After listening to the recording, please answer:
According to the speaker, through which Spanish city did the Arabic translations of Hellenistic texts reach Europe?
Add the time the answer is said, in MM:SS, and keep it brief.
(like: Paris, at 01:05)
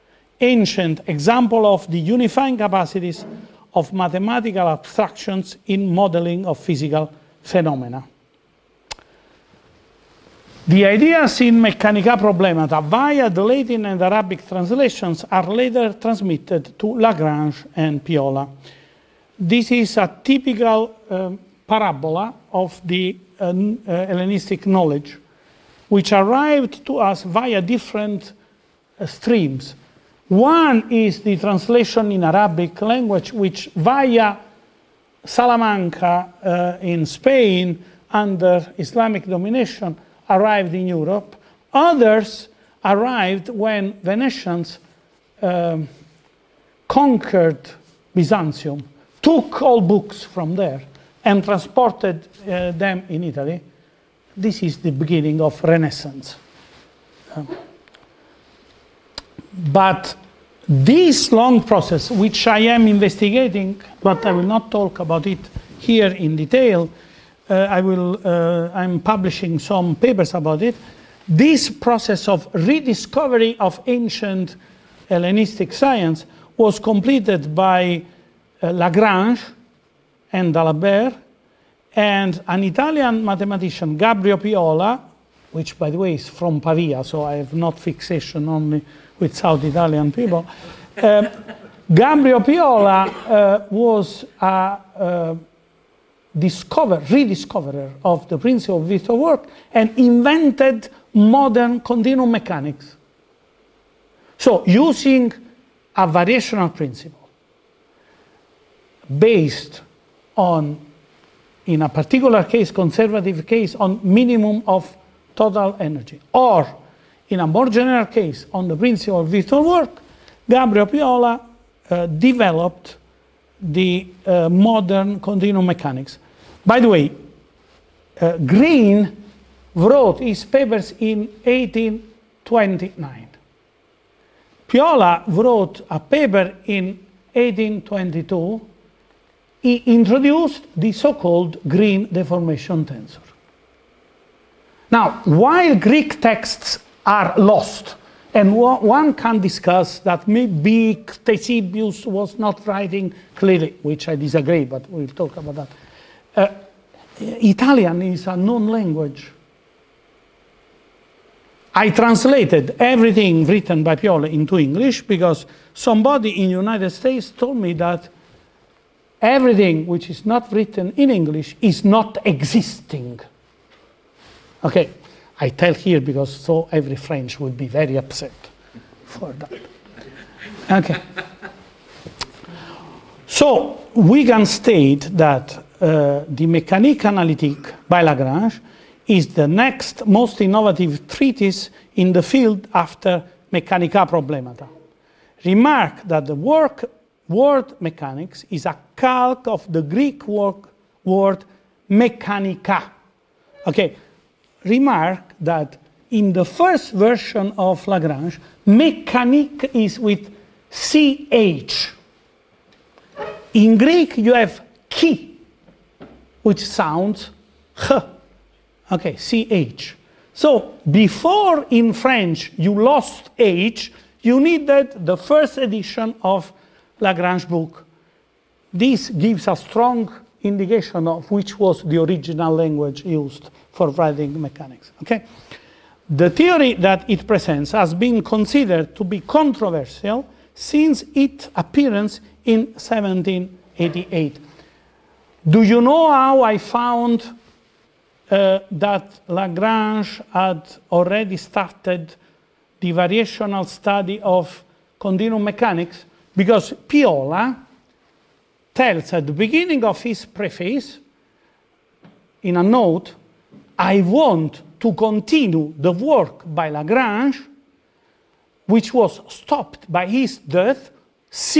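Salamanca, at 00:35.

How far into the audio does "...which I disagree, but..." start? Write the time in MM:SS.
02:33.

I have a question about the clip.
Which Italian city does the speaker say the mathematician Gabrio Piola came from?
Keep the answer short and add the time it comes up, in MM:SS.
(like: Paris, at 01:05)
Pavia, at 01:26.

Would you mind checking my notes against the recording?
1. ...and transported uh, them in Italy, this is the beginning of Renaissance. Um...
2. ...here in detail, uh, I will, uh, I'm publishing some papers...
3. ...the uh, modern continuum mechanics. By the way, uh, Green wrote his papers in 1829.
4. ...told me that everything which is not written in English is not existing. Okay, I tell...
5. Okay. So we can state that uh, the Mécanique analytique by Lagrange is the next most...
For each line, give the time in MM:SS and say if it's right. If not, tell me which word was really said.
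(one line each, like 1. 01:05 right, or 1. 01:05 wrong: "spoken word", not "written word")
1. 00:51 right
2. 01:05 right
3. 02:03 right
4. 02:47 right
5. 03:00 right.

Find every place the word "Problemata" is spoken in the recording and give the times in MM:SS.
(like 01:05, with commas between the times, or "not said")
00:12, 03:14.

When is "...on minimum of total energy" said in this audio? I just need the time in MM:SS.
01:53.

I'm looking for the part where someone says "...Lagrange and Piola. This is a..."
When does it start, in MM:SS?
00:16.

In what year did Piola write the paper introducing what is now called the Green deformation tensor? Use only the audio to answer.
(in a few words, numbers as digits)
1822.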